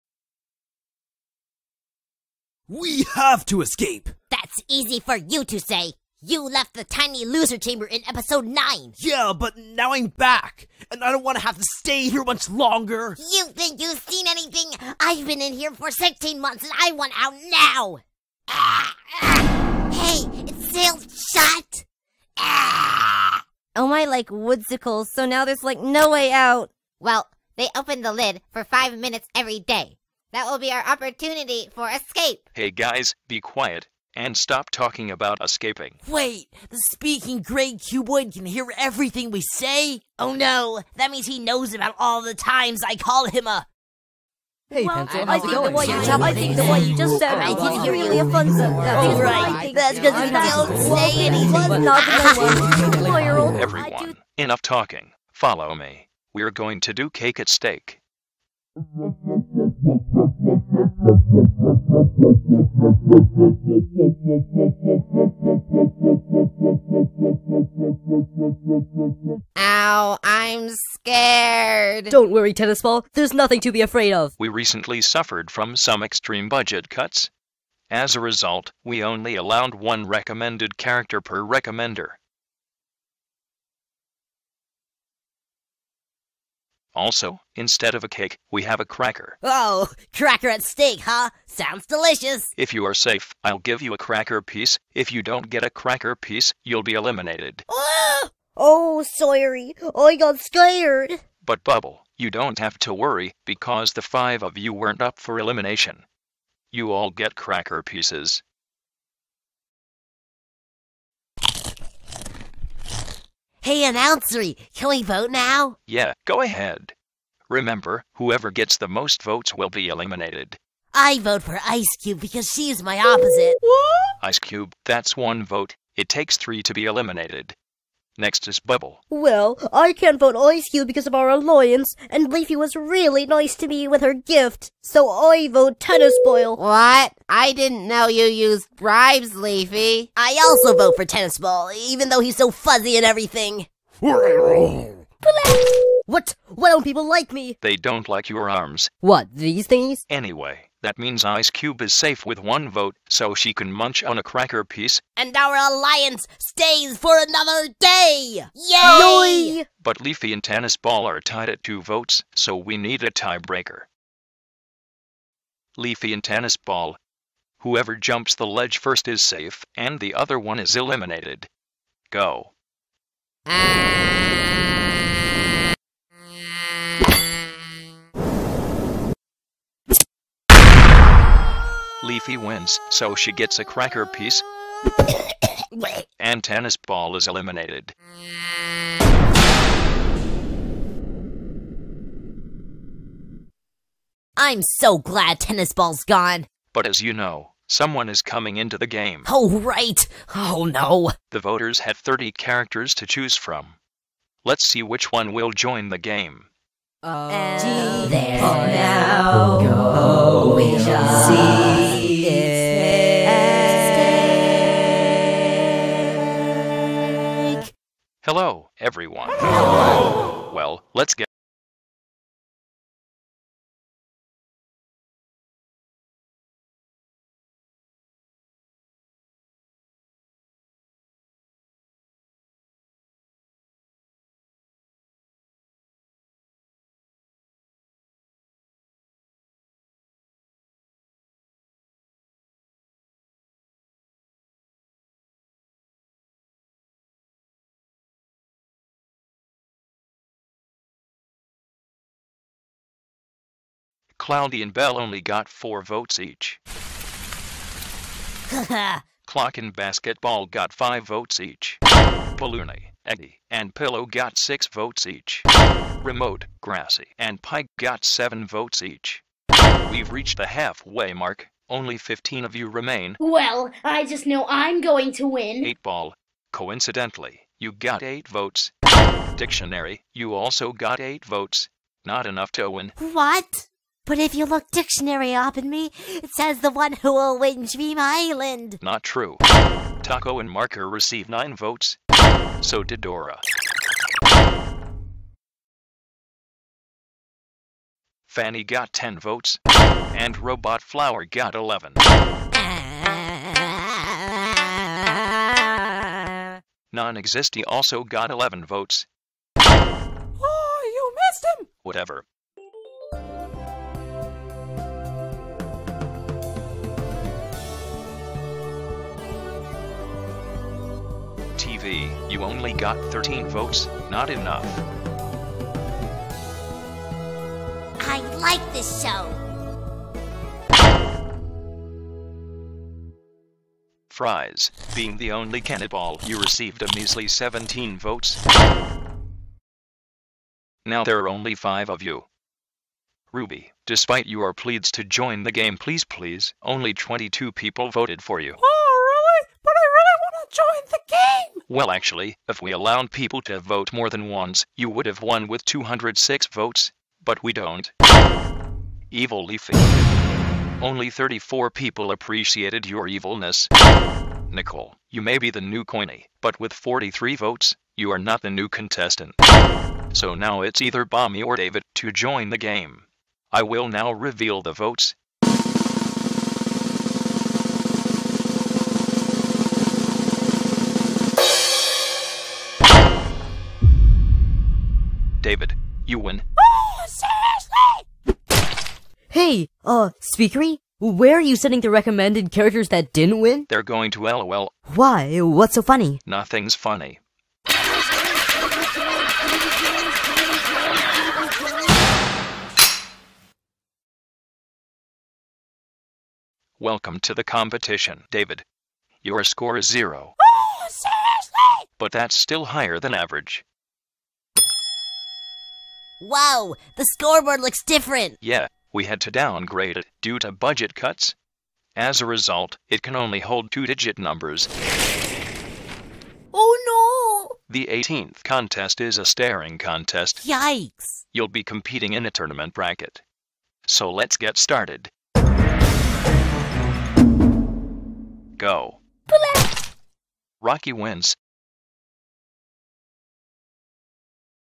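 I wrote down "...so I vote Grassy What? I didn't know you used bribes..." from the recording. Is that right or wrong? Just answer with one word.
wrong.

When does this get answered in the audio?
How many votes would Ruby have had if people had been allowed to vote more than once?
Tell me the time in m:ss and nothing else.
5:55.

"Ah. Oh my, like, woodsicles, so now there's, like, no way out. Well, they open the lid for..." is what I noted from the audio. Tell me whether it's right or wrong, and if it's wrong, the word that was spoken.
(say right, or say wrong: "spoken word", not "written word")
right.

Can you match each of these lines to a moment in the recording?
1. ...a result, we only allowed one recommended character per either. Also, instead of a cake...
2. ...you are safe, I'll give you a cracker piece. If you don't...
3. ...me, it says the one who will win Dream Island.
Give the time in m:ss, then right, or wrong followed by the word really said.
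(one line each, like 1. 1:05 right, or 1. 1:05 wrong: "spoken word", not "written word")
1. 1:18 wrong: "recommender", not "either"
2. 1:32 right
3. 4:45 right.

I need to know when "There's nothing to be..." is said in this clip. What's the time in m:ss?
1:13.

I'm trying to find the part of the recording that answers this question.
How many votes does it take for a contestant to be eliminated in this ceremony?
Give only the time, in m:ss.
2:06.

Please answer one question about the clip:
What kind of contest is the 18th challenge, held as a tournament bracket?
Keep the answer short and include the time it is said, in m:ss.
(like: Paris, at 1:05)
staring contest, at 7:09.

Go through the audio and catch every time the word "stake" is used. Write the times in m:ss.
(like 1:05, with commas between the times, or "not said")
0:57, 1:30.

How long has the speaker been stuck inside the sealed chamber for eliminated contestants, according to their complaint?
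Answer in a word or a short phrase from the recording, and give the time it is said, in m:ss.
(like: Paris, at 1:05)
16 months, at 0:15.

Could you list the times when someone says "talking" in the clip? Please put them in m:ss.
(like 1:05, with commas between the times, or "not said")
0:34, 0:54.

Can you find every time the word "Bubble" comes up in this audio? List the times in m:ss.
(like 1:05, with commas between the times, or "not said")
1:41, 2:08.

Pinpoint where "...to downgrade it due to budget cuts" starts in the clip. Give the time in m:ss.
6:59.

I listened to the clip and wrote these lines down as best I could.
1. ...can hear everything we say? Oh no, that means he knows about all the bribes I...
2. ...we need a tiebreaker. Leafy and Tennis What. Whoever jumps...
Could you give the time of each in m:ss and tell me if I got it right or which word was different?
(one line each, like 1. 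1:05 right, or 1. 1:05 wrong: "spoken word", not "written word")
1. 0:38 wrong: "times", not "bribes"
2. 2:42 wrong: "Ball", not "What".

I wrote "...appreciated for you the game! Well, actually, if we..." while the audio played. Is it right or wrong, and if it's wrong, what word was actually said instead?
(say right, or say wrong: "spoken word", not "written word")
wrong: "voted", not "appreciated".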